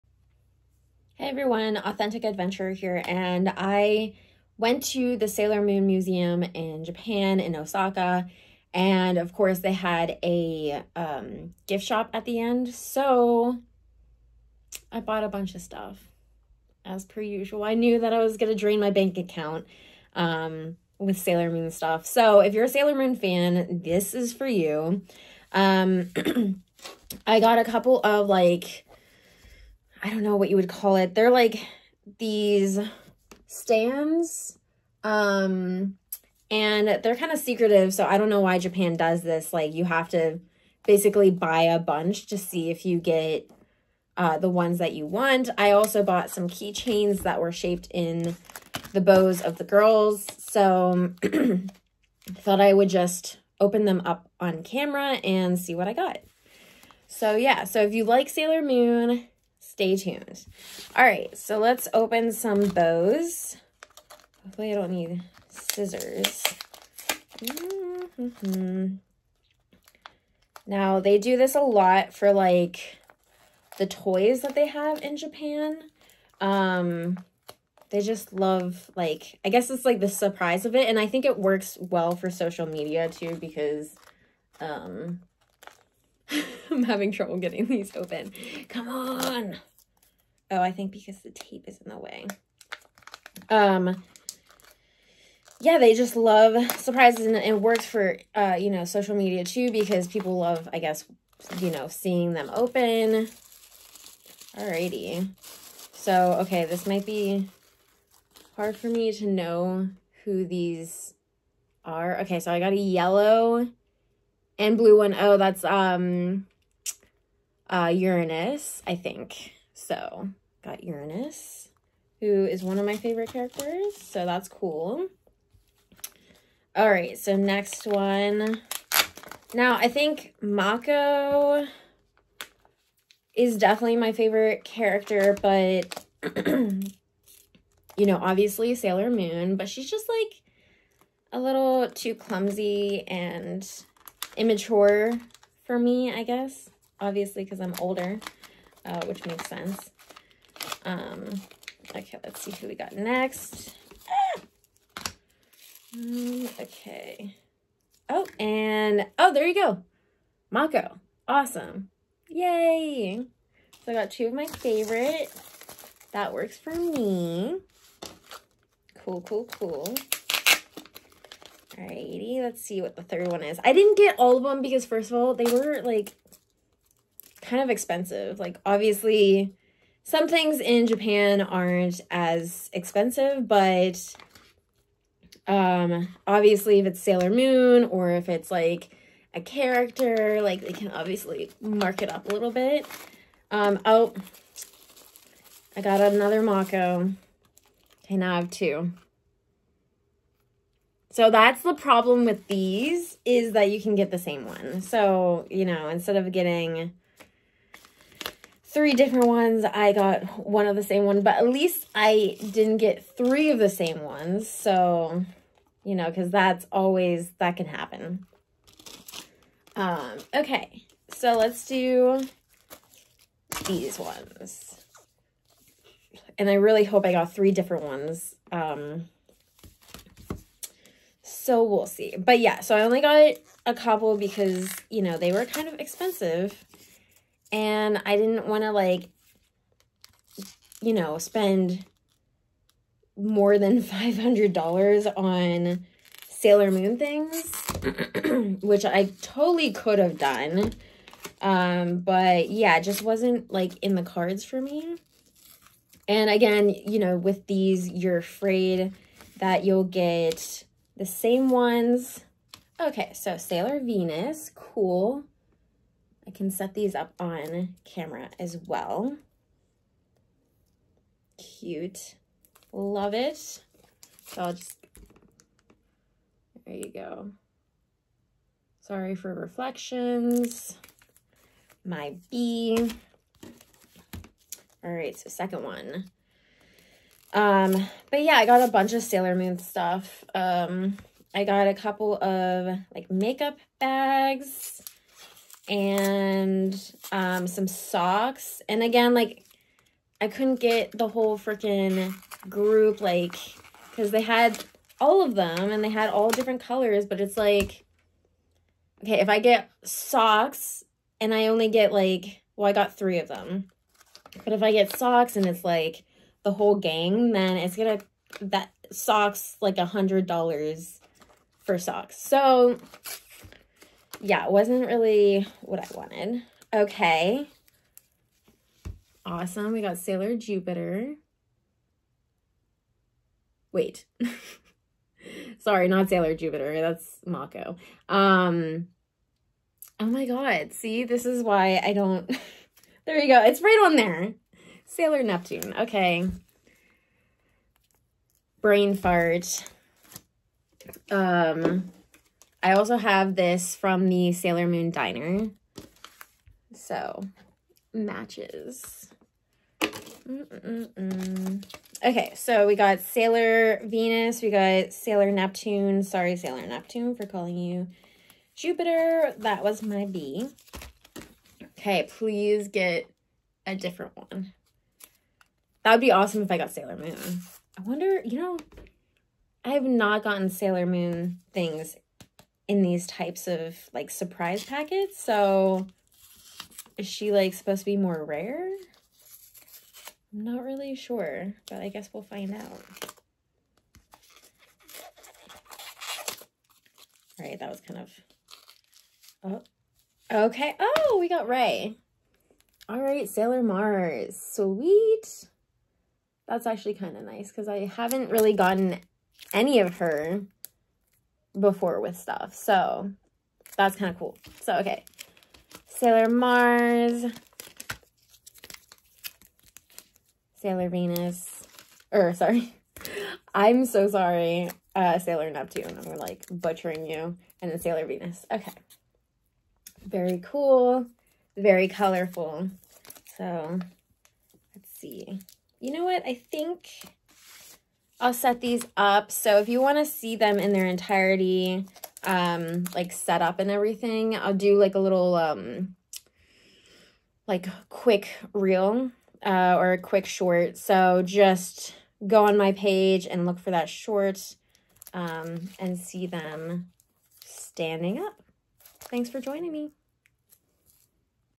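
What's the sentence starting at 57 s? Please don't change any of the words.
So yeah, so if you like Sailor Moon, stay tuned.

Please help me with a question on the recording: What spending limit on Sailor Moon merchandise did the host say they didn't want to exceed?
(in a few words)
$500.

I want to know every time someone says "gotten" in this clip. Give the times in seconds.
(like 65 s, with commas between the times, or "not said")
380 s, 408 s.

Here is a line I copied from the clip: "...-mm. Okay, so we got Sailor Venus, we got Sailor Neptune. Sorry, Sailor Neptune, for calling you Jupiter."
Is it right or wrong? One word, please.
right.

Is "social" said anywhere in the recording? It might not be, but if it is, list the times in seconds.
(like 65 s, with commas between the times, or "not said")
82 s, 98 s.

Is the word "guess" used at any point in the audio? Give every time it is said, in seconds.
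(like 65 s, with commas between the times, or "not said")
79 s, 100 s, 146 s, 391 s.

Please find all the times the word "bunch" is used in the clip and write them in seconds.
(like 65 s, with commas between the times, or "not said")
15 s, 41 s, 288 s.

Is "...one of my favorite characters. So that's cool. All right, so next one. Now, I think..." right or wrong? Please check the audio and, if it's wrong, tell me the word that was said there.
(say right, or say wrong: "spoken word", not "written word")
right.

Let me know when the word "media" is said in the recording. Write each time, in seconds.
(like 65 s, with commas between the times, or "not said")
82 s, 99 s.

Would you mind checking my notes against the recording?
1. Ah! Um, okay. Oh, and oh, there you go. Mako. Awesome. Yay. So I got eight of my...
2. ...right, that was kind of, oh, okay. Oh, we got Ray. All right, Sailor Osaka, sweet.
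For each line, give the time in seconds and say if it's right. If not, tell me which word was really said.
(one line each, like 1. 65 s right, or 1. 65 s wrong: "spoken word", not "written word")
1. 154 s wrong: "two", not "eight"
2. 397 s wrong: "Mars", not "Osaka".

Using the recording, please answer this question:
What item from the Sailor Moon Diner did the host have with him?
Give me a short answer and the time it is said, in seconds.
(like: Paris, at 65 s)
matches, at 357 s.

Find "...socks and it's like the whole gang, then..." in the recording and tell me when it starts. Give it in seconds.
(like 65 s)
314 s.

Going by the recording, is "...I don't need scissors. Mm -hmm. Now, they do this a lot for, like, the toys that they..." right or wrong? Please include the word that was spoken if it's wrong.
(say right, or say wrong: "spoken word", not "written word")
right.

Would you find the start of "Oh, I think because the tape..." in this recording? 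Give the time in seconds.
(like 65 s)
90 s.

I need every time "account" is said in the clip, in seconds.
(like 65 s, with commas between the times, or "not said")
19 s.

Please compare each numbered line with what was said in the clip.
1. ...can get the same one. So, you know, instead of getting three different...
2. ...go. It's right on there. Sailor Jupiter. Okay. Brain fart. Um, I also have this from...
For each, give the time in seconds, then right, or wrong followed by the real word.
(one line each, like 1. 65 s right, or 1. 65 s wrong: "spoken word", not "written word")
1. 203 s right
2. 343 s wrong: "Neptune", not "Jupiter".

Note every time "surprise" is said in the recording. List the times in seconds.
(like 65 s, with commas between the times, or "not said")
80 s, 96 s, 384 s.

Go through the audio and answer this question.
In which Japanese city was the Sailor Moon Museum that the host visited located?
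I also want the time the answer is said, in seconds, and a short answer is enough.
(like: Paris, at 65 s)
Osaka, at 7 s.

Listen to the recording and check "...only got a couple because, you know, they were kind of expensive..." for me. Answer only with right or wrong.
right.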